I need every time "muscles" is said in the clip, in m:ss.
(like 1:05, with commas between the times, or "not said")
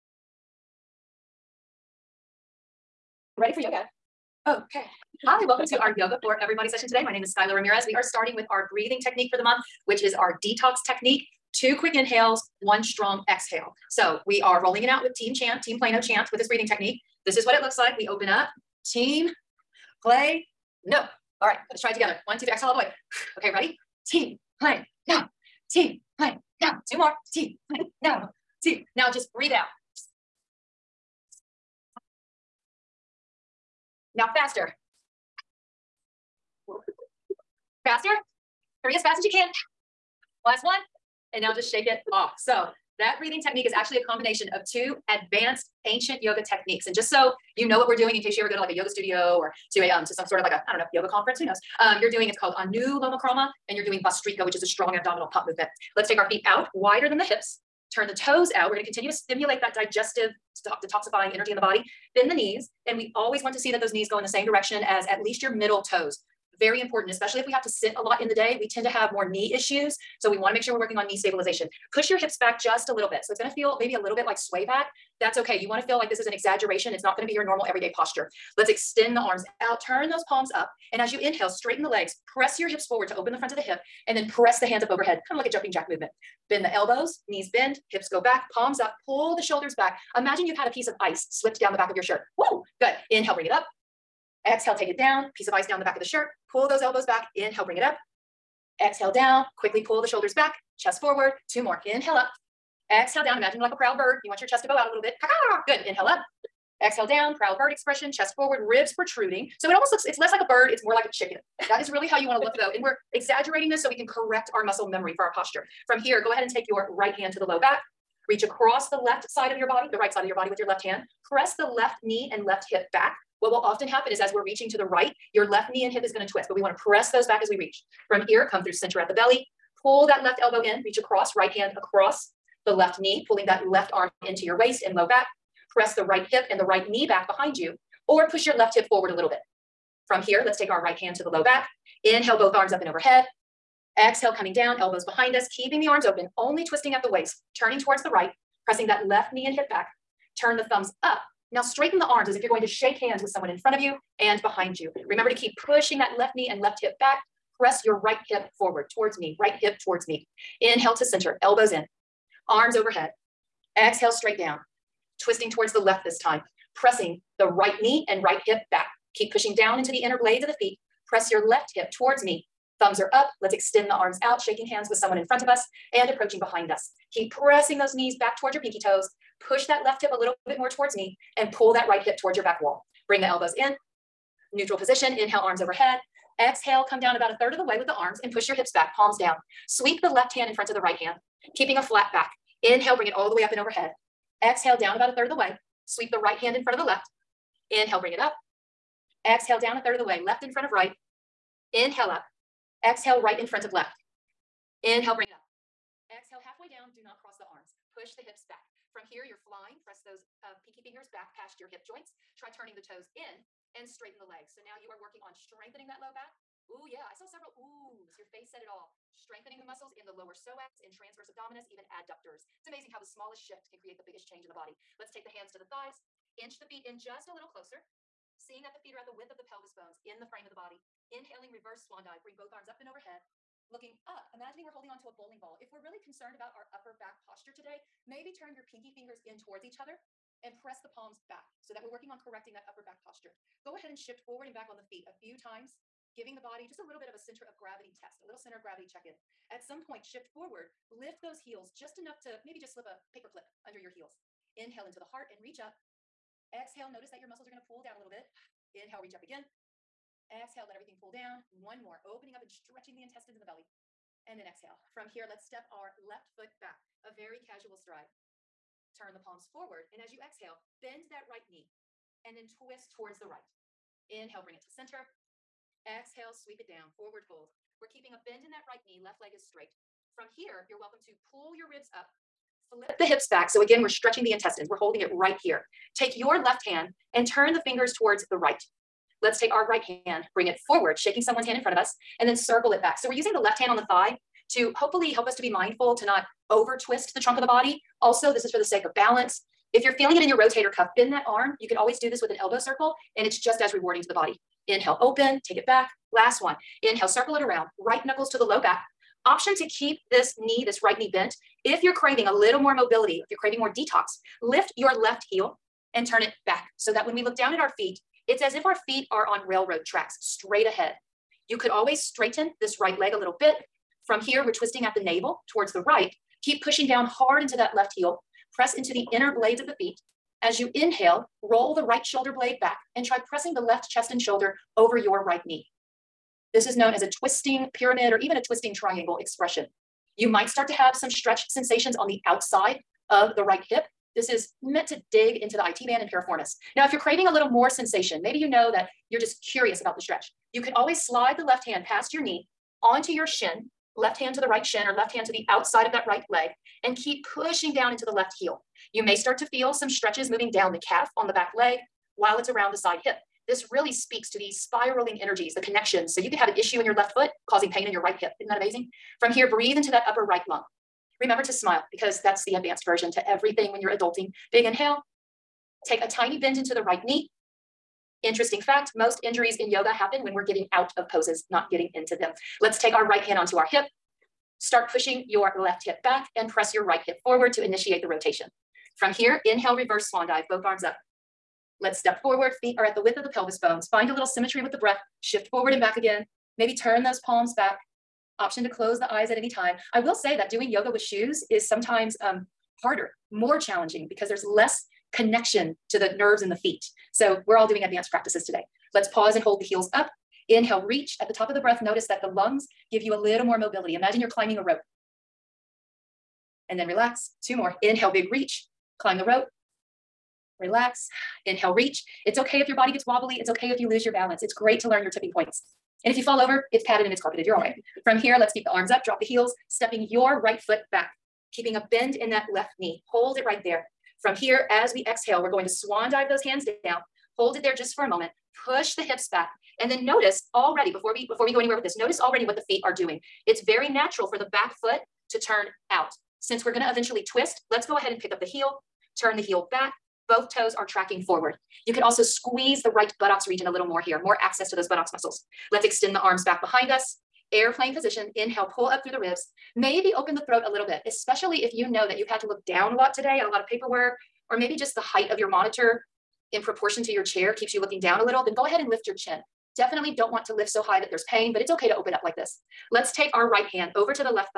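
1:54, 3:39, 4:17, 7:35.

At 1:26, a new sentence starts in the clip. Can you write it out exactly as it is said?
Bend the elbows, knees bend, hips go back, palms up, pull the shoulders back.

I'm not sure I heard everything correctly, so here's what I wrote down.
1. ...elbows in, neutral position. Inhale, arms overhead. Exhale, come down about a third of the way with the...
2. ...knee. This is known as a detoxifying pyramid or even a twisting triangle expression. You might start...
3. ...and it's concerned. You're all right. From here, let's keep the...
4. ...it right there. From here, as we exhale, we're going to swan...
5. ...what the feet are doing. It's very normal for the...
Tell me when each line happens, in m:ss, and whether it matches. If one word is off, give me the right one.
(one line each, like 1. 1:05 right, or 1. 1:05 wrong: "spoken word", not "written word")
1. 3:03 right
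2. 5:35 wrong: "twisting", not "detoxifying"
3. 7:07 wrong: "carpeted", not "concerned"
4. 7:13 right
5. 7:22 wrong: "natural", not "normal".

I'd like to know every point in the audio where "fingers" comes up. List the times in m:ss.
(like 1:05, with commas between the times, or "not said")
3:30, 3:58, 4:47.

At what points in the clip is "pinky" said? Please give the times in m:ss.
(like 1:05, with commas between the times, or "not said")
2:58, 3:30, 3:58.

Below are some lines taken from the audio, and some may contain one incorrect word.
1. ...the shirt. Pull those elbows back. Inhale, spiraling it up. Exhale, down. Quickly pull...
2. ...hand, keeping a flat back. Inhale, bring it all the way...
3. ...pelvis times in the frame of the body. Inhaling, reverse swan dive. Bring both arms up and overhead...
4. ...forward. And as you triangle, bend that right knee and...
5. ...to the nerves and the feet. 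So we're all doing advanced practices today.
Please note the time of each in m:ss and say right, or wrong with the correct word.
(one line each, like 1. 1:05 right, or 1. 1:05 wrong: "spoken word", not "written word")
1. 1:35 wrong: "bring", not "spiraling"
2. 3:10 right
3. 3:49 wrong: "bones", not "times"
4. 4:29 wrong: "exhale", not "triangle"
5. 6:45 right.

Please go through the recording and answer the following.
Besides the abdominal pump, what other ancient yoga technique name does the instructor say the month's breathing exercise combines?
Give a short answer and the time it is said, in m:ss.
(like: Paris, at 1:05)
Anuloma Krama, at 0:52.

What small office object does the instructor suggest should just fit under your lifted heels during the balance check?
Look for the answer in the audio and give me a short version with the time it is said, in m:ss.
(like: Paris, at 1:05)
paper clip, at 4:13.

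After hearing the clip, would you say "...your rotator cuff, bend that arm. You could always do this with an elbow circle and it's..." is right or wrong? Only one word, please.
right.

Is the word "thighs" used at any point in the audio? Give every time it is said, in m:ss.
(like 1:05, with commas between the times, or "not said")
3:45, 4:53.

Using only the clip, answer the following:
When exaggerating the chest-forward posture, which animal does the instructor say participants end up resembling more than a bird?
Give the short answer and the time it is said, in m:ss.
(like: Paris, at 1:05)
chicken, at 1:51.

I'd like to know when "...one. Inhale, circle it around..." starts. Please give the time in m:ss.
5:06.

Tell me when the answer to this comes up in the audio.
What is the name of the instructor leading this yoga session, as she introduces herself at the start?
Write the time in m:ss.
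0:07.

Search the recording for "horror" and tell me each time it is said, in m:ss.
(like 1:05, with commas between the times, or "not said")
not said.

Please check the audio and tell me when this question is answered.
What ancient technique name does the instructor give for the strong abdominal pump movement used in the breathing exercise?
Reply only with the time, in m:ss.
0:54.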